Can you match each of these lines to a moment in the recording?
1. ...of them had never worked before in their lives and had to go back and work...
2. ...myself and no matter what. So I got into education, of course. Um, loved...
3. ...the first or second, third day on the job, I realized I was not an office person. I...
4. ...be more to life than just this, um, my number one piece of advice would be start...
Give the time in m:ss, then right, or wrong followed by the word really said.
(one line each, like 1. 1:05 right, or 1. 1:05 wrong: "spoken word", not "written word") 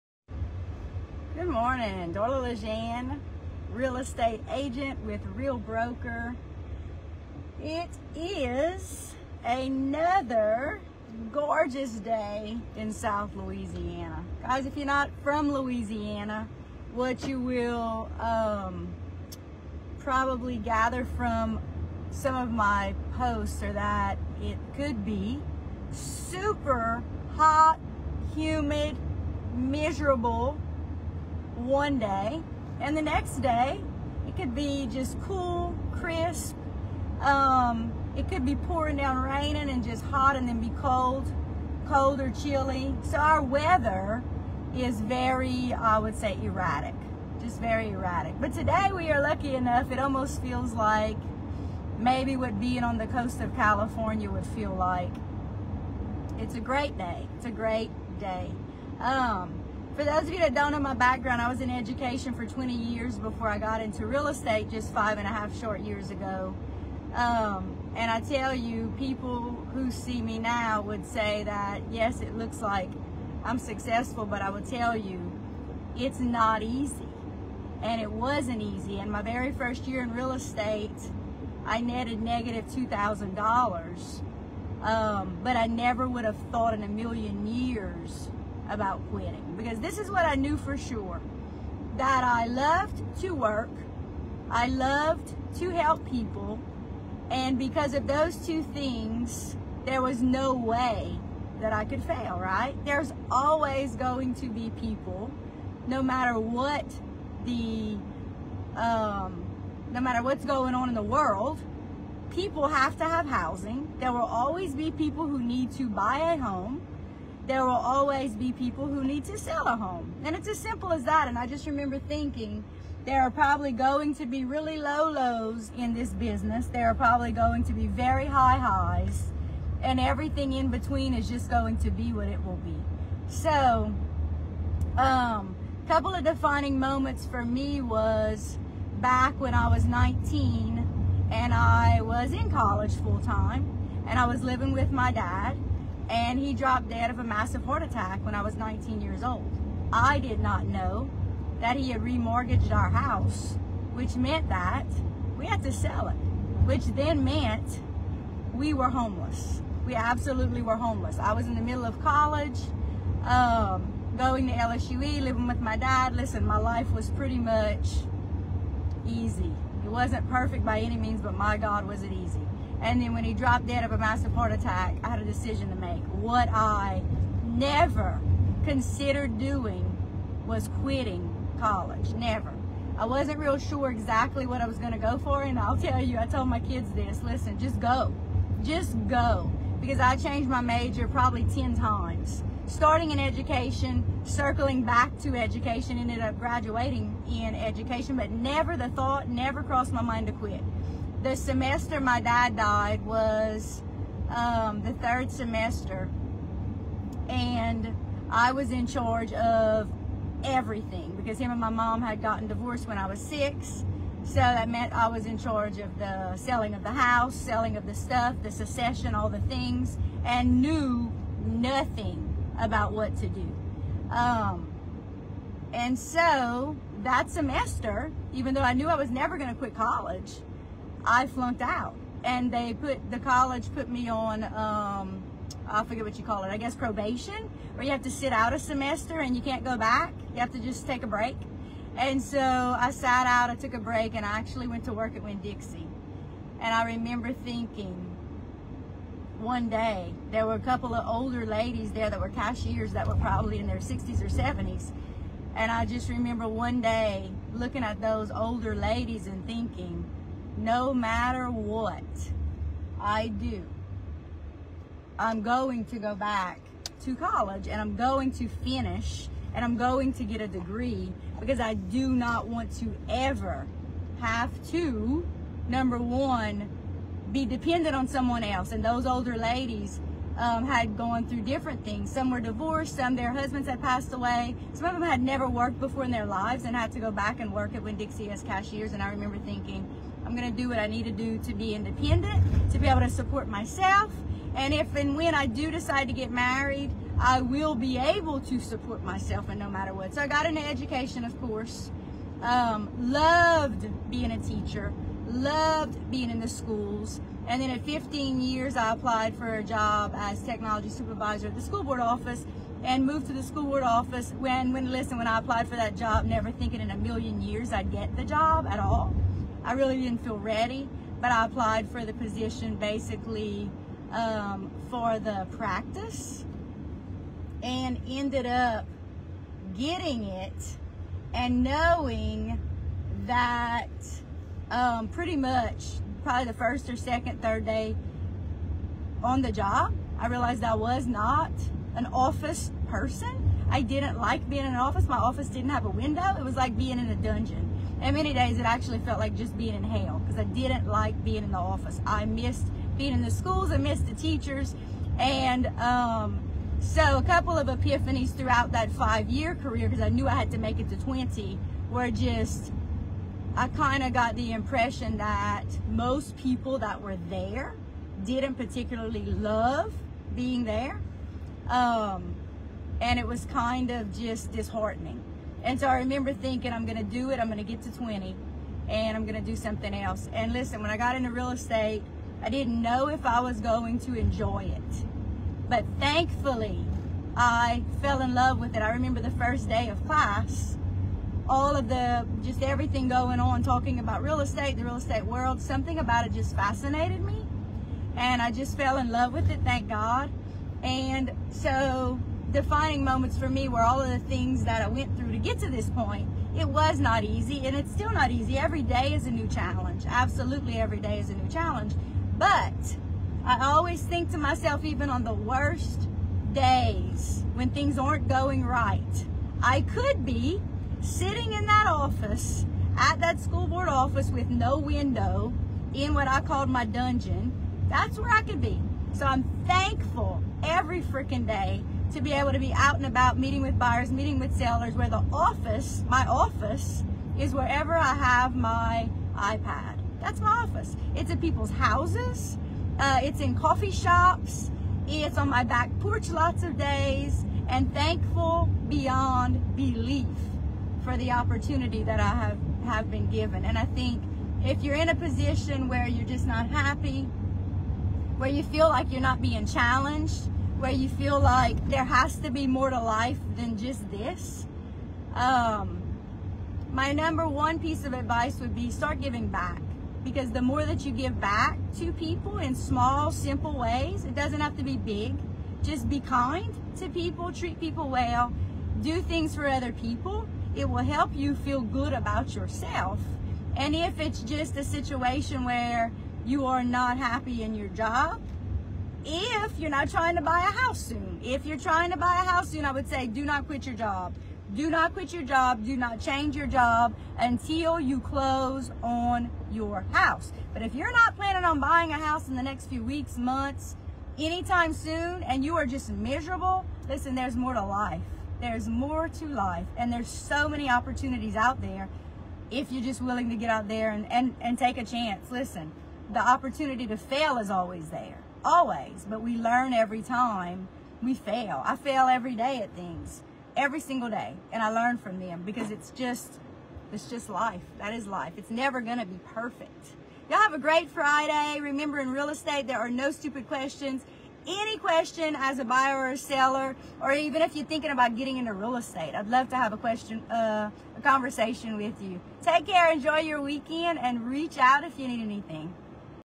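1. 4:44 right
2. 4:59 right
3. 5:36 right
4. 7:42 right.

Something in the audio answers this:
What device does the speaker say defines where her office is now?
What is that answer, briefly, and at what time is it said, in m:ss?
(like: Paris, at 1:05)
iPad, at 7:19.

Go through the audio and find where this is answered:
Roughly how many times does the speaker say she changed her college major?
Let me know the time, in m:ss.
3:11.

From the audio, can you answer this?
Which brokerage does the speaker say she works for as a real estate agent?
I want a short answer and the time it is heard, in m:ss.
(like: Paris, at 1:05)
Real Broker, at 0:05.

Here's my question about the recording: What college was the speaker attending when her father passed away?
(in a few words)
LSUE.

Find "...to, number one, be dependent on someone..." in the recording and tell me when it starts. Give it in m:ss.
4:34.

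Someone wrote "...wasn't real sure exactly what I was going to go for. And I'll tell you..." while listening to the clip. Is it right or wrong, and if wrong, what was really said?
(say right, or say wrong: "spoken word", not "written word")
right.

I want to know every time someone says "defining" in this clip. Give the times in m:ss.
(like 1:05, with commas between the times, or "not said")
2:16, 6:42.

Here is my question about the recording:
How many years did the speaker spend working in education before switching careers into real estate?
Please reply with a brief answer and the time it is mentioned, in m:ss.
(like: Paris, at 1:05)
20, at 1:02.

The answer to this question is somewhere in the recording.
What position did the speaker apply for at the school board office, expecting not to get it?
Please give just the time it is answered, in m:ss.
5:10.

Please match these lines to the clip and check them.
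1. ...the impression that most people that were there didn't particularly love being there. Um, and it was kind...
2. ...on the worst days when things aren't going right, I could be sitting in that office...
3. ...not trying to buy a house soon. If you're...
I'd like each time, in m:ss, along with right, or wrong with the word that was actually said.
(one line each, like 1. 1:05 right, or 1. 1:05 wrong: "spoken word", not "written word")
1. 6:04 right
2. 6:55 right
3. 8:09 right.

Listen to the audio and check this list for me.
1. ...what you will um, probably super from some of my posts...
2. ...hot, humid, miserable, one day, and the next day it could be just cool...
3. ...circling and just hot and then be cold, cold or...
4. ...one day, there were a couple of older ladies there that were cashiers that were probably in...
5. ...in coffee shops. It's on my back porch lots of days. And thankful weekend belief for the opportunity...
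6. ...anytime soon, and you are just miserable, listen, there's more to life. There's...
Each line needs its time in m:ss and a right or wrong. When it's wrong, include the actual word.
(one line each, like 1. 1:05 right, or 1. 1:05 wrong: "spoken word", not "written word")
1. 0:16 wrong: "gather", not "super"
2. 0:27 right
3. 0:39 wrong: "raining", not "circling"
4. 4:09 right
5. 7:23 wrong: "beyond", not "weekend"
6. 8:24 right.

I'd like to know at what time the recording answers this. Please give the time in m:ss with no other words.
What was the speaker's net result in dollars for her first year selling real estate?
1:22.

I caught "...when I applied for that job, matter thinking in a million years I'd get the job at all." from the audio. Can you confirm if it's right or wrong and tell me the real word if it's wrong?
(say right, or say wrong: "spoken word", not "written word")
wrong: "never", not "matter".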